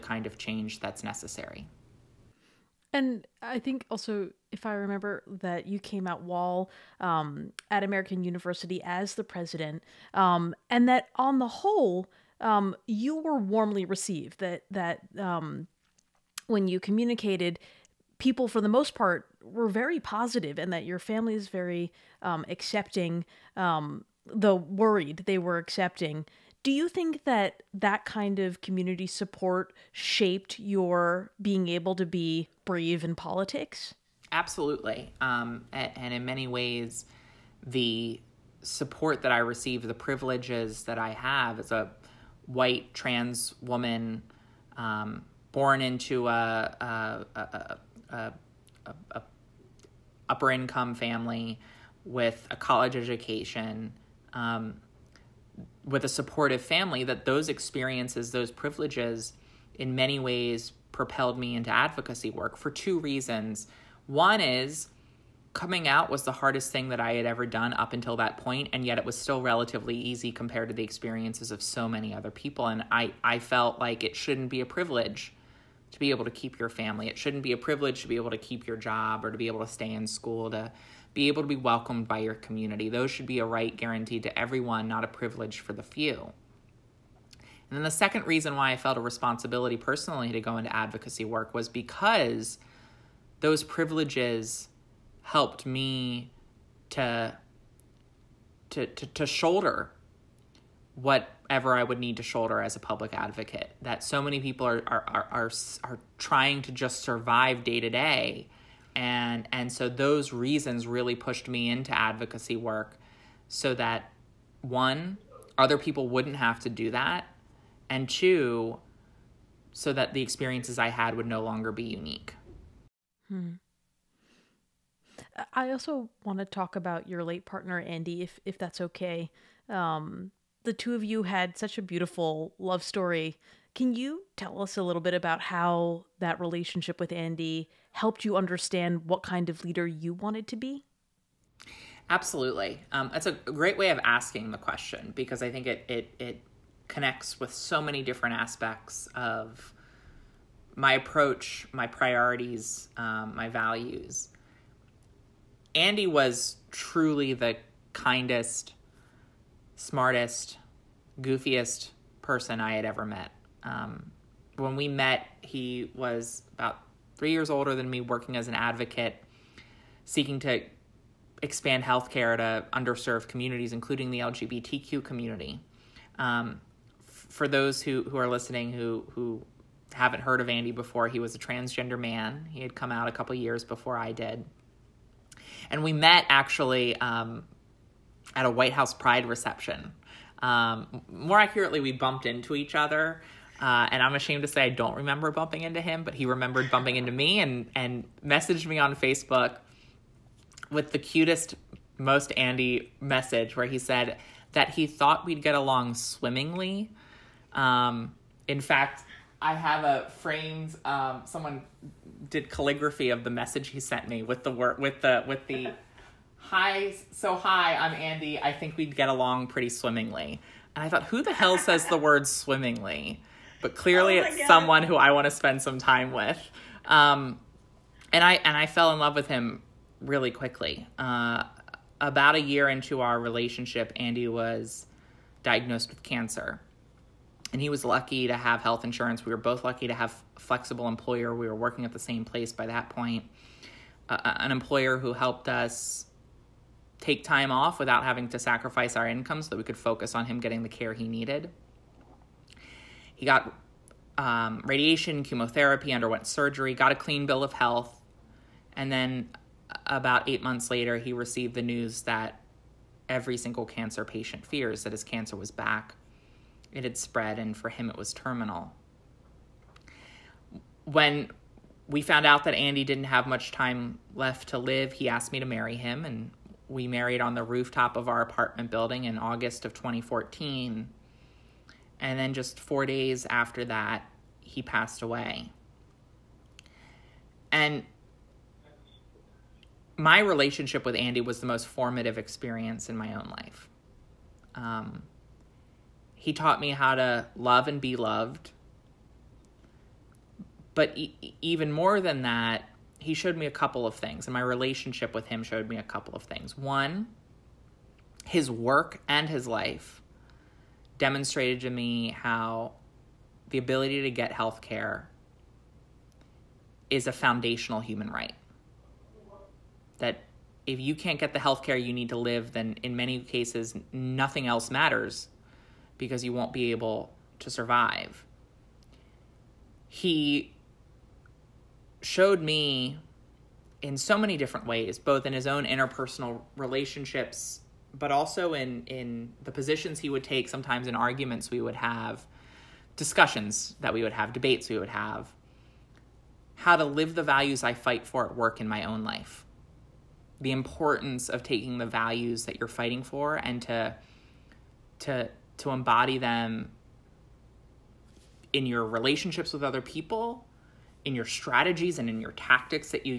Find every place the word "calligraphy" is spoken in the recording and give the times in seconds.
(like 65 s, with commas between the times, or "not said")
212 s.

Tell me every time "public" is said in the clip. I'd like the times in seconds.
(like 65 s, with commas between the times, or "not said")
102 s.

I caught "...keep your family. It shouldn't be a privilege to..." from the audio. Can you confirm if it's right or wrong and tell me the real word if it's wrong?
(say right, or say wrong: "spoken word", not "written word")
right.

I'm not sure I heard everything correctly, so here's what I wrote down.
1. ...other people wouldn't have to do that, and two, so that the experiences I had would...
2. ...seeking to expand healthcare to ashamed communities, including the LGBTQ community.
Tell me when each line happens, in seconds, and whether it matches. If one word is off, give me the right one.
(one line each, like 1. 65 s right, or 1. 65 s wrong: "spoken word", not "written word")
1. 115 s right
2. 170 s wrong: "underserved", not "ashamed".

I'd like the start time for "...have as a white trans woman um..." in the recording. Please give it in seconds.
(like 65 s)
41 s.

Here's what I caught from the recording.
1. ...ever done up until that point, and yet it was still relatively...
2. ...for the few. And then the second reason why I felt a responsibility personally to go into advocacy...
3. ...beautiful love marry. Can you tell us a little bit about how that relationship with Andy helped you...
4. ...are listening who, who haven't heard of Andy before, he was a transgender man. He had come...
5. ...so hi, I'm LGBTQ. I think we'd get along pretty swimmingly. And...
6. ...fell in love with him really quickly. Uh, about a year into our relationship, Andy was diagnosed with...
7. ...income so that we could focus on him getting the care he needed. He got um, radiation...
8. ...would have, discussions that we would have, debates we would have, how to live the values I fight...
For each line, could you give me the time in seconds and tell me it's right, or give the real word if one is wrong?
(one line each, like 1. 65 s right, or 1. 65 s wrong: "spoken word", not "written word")
1. 67 s right
2. 85 s right
3. 131 s wrong: "story", not "marry"
4. 178 s right
5. 217 s wrong: "Andy", not "LGBTQ"
6. 228 s right
7. 249 s right
8. 341 s right.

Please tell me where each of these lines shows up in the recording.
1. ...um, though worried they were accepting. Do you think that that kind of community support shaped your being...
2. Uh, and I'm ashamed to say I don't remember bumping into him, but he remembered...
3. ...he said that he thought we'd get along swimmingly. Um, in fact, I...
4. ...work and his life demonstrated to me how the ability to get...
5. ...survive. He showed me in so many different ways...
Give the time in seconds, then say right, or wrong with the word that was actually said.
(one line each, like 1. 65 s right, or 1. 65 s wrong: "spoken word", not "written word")
1. 23 s right
2. 193 s right
3. 203 s right
4. 308 s right
5. 327 s right.